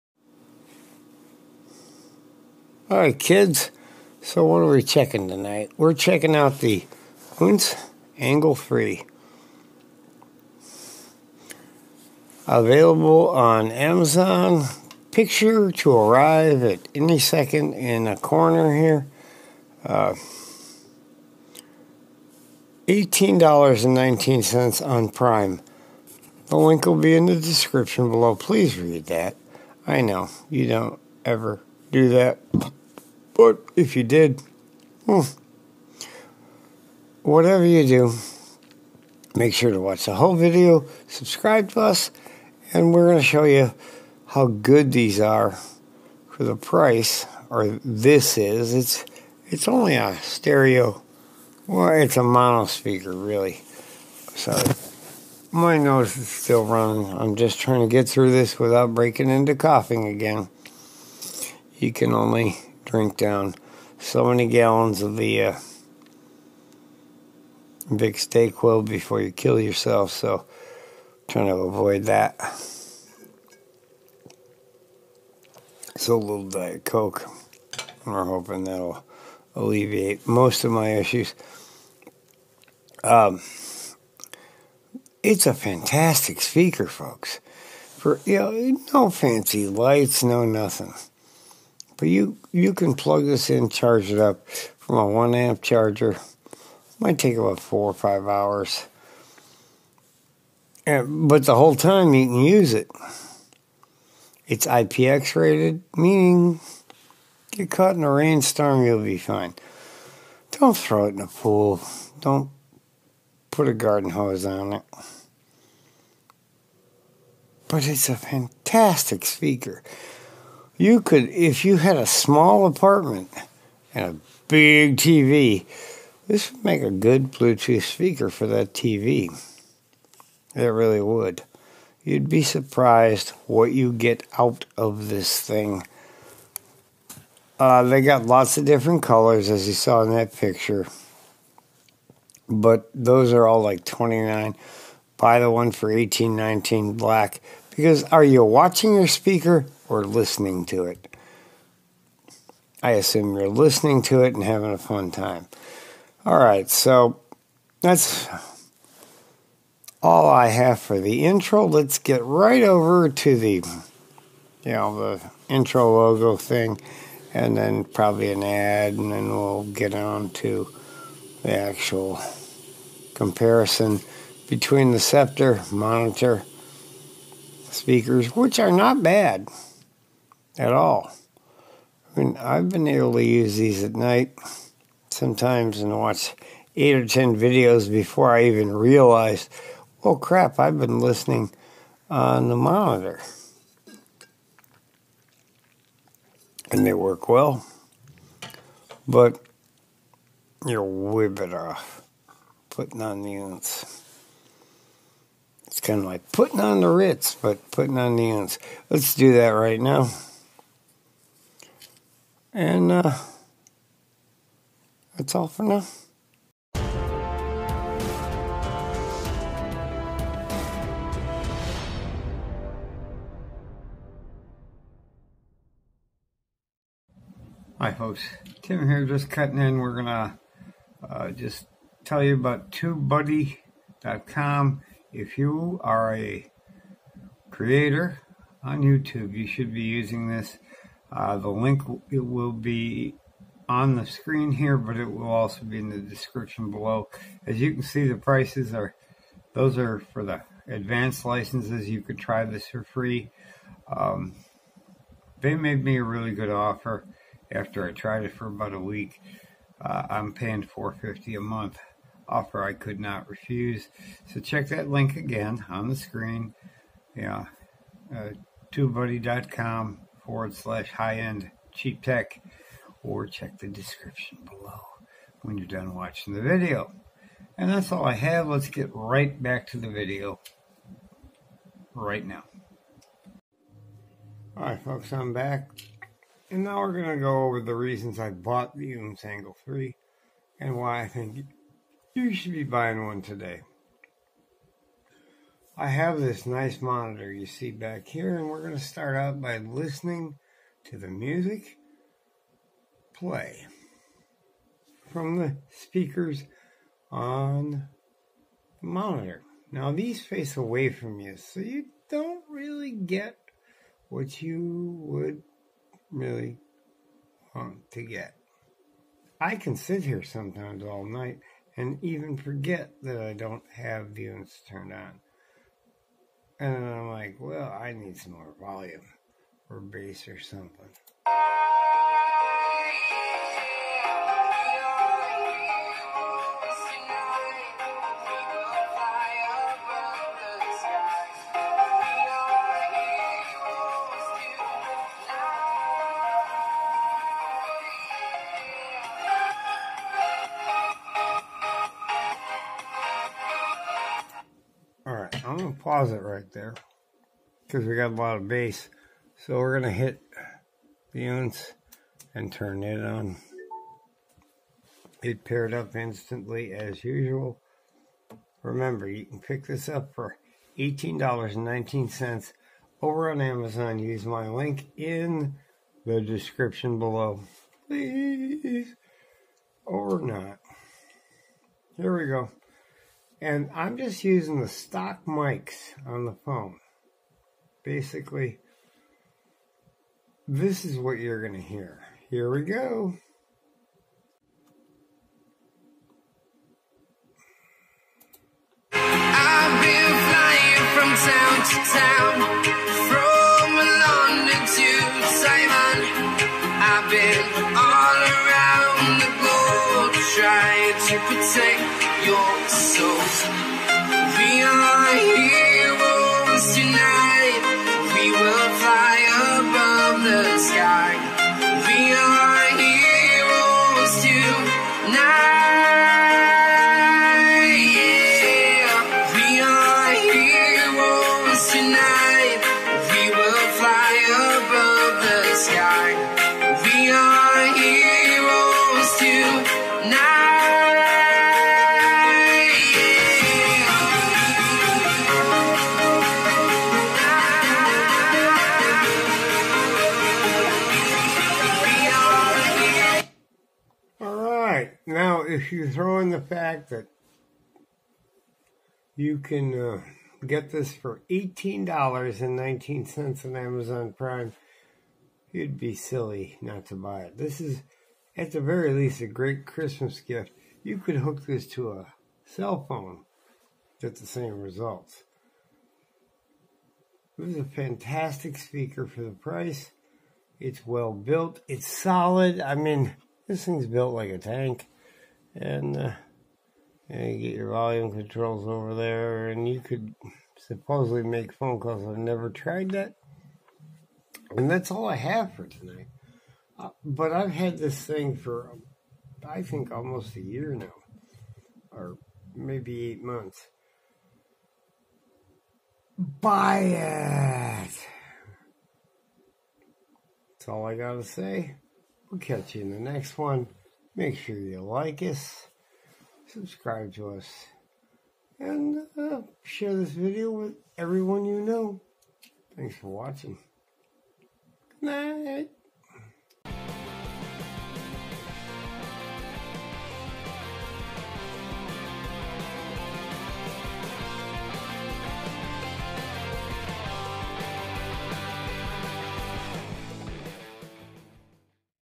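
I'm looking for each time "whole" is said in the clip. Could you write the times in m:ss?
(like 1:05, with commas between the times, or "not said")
0:40, 1:41.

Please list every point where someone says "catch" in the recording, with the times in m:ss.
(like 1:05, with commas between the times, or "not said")
8:32.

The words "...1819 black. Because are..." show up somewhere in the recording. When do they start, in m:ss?
2:25.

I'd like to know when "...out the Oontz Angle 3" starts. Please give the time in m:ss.
0:06.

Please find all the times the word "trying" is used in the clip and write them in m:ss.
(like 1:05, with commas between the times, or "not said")
0:57, 1:11.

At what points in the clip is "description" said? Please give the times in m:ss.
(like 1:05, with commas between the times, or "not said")
0:27, 4:05, 4:33, 6:16.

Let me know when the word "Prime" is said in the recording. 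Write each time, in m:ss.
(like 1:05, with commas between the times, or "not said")
0:25, 7:44.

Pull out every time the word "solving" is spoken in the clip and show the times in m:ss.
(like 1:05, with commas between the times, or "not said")
not said.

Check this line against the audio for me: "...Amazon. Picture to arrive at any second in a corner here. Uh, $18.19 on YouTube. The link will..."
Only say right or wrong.
wrong.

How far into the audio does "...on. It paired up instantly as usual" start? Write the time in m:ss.
6:03.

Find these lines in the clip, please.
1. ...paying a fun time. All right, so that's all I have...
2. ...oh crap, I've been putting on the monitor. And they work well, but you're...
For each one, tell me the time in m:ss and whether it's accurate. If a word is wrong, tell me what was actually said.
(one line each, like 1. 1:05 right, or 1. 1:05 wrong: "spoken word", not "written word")
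1. 2:34 wrong: "having", not "paying"
2. 3:10 wrong: "listening", not "putting".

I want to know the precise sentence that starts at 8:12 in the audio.
I've never tried that, and that's all I have for tonight.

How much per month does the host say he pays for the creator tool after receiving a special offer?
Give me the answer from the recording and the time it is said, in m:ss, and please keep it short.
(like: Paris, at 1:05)
$4.50, at 4:20.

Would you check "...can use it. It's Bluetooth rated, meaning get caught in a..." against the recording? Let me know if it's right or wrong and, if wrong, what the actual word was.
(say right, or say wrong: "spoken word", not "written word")
wrong: "IPX", not "Bluetooth".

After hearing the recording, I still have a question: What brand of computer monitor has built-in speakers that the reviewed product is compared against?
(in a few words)
Sceptre.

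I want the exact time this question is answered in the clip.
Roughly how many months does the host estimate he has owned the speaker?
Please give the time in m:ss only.
8:23.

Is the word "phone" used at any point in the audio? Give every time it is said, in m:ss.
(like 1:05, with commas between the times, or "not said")
7:52, 8:11.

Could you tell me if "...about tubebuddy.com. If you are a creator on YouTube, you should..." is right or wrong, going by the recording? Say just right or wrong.
right.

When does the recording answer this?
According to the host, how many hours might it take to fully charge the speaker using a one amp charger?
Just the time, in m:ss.
1:37.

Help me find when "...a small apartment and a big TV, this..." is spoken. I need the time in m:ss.
2:01.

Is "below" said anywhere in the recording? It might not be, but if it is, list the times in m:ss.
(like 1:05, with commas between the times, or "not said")
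0:28, 4:06, 4:34, 6:16.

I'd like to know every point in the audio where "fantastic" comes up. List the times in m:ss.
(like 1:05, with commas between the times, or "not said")
1:25, 1:58, 7:57.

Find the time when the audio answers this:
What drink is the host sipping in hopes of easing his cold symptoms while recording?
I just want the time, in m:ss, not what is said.
1:16.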